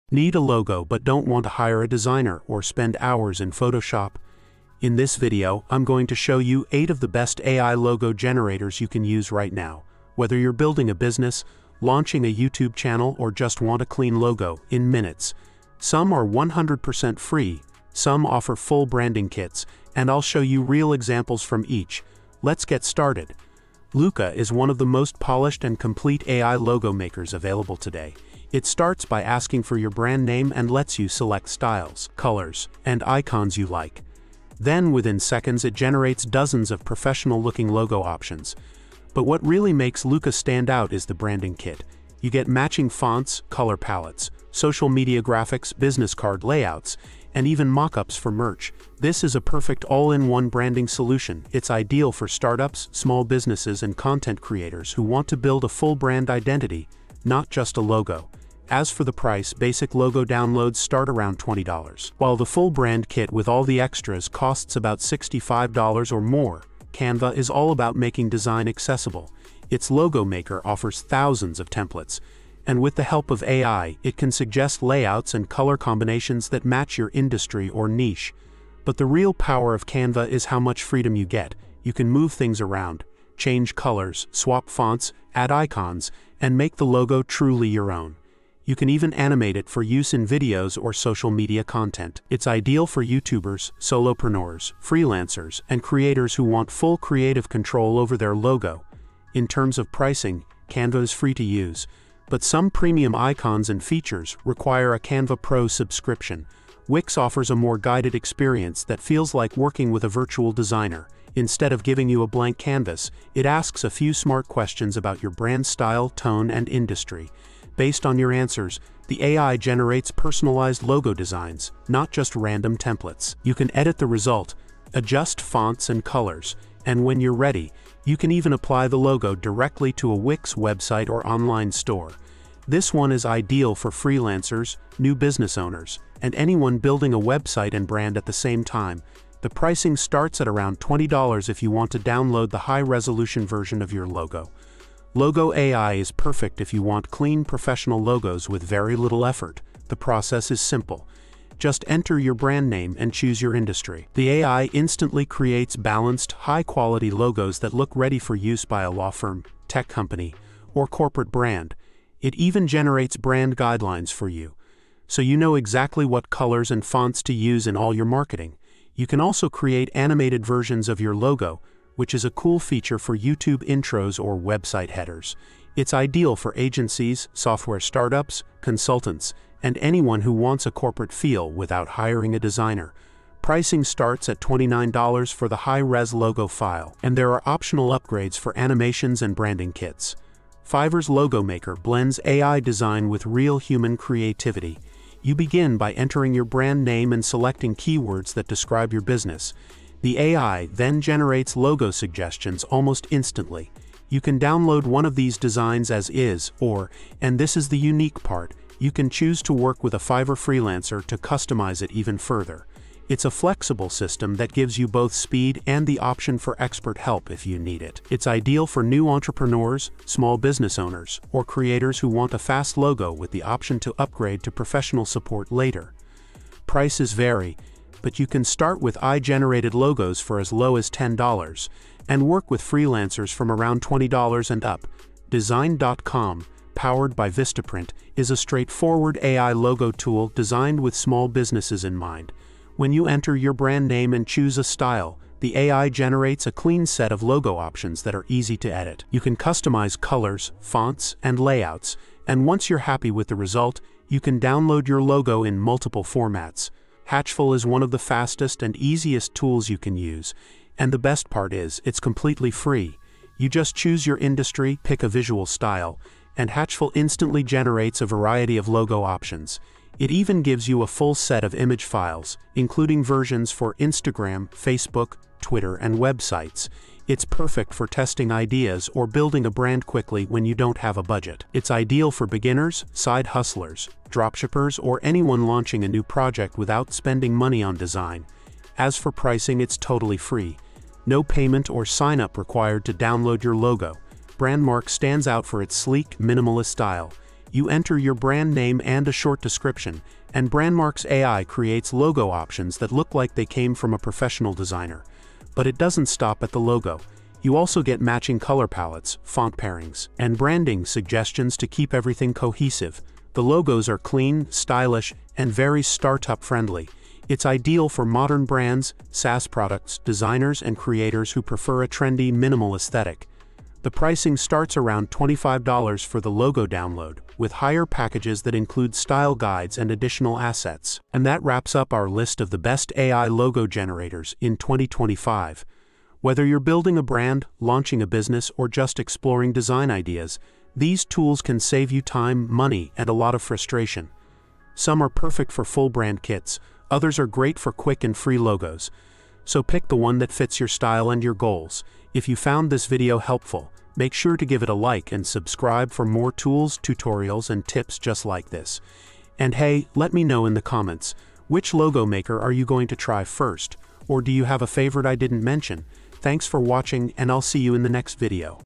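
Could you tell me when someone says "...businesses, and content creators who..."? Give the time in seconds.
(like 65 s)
53 s.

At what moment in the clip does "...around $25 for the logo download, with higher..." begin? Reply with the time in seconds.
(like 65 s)
324 s.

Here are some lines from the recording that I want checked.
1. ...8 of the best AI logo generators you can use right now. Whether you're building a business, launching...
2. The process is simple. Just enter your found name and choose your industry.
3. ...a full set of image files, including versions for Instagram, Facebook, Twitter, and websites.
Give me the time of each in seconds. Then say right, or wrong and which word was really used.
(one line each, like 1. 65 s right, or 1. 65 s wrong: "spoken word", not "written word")
1. 6 s right
2. 149 s wrong: "brand", not "found"
3. 270 s right.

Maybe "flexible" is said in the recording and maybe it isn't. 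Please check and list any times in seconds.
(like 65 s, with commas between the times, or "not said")
213 s.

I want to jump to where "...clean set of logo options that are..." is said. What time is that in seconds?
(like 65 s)
246 s.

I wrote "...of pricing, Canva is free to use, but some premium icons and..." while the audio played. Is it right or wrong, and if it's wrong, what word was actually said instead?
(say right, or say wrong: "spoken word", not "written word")
right.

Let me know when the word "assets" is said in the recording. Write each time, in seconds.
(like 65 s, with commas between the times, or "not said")
330 s.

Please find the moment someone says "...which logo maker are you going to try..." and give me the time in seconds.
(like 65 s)
361 s.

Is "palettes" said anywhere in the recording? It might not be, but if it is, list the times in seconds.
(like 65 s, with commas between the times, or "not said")
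43 s, 308 s.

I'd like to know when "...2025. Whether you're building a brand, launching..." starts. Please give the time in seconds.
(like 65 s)
334 s.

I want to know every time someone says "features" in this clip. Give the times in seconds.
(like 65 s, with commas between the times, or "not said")
103 s, 172 s.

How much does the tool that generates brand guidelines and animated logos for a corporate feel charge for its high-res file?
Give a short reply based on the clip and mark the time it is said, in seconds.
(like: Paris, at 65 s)
$29, at 184 s.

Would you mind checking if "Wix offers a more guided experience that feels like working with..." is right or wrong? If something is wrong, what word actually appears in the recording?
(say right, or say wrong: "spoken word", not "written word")
right.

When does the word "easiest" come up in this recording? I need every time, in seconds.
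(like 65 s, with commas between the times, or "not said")
258 s.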